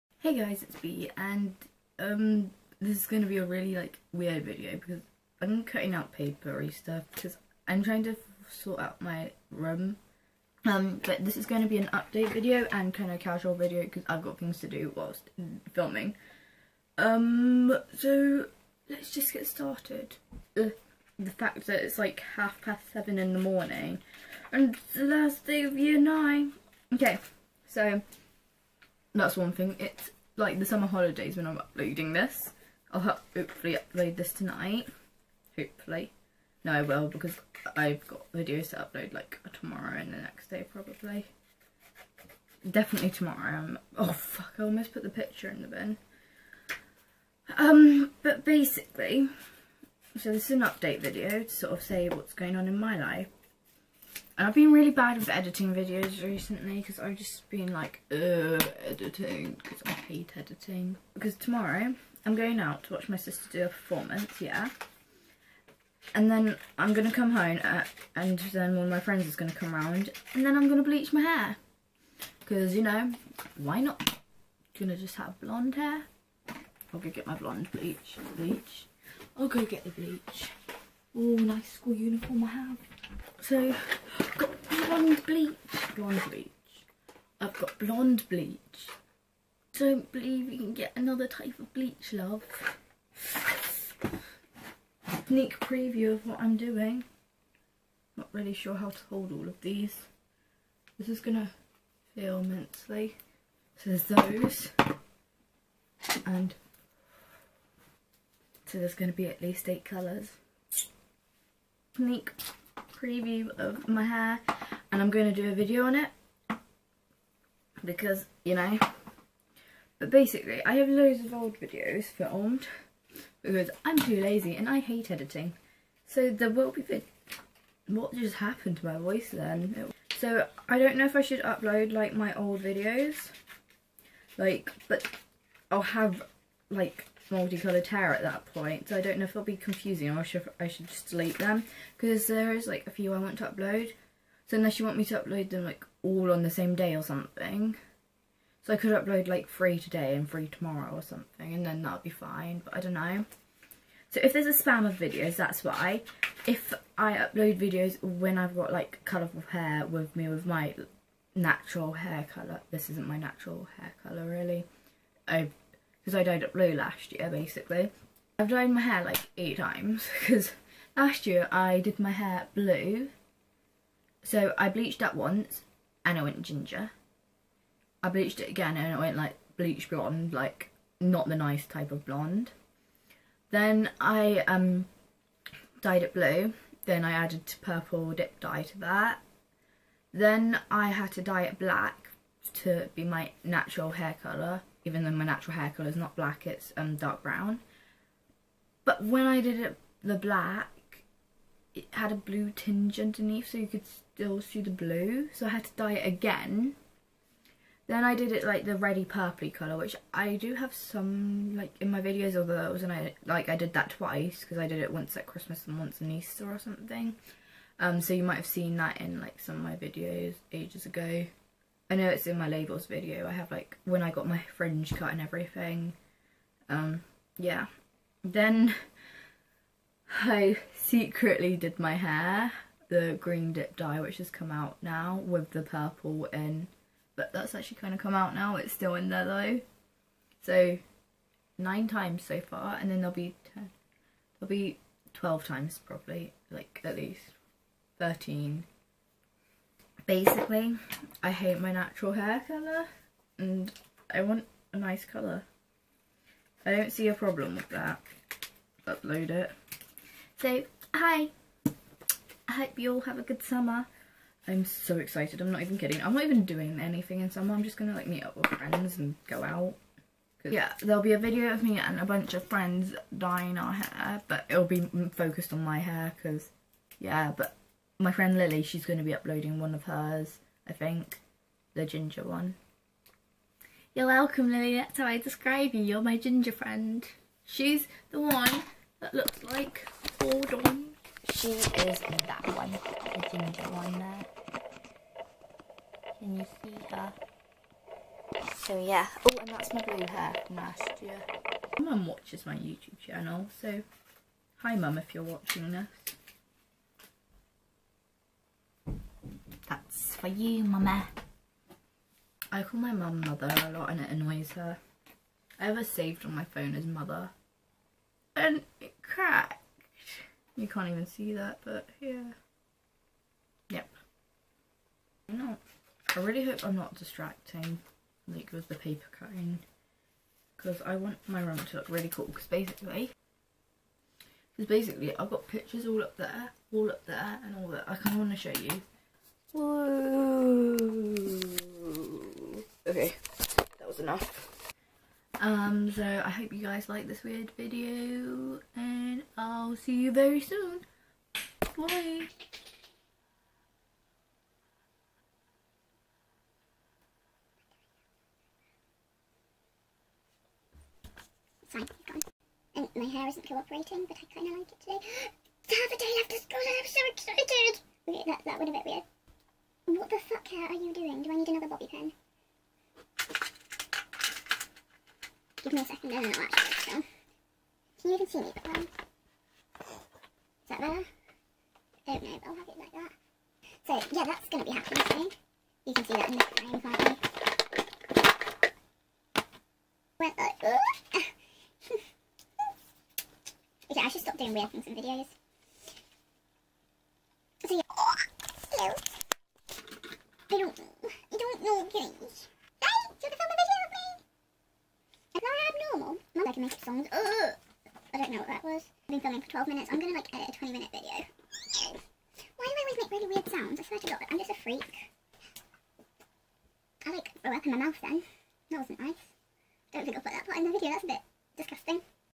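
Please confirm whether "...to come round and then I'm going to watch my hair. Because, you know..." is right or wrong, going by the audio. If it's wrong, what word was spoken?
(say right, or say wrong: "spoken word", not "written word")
wrong: "bleach", not "watch".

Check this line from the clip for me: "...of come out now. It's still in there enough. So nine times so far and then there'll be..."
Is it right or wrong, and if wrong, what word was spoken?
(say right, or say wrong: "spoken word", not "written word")
wrong: "though", not "enough".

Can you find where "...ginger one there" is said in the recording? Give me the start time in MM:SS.
04:53.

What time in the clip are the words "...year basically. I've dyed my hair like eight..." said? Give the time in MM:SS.
02:47.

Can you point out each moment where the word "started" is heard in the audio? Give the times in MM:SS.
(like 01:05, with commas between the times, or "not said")
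00:19.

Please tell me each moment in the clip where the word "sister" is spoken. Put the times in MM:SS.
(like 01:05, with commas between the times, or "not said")
01:03.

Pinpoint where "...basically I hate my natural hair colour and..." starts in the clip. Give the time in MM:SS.
04:10.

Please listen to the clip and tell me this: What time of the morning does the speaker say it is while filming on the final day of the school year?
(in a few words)
half past seven.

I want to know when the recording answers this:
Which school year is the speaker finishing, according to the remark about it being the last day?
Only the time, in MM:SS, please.
00:25.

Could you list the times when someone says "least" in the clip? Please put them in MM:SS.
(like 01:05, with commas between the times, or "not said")
01:49, 04:06.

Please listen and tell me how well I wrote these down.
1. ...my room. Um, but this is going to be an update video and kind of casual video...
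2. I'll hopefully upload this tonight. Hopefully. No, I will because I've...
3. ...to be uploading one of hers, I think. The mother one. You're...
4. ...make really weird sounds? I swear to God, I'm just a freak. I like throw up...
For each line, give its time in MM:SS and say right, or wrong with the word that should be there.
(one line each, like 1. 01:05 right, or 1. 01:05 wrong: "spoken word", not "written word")
1. 00:09 right
2. 00:32 right
3. 04:38 wrong: "ginger", not "mother"
4. 06:53 right.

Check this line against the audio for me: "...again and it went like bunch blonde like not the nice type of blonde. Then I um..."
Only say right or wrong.
wrong.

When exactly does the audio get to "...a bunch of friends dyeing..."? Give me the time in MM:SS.
04:32.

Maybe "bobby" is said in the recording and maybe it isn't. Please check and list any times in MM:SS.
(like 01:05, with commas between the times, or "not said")
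06:11.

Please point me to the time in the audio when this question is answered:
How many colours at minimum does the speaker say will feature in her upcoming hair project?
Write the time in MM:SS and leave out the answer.
01:49.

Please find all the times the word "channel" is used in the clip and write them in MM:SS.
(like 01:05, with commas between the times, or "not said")
05:02.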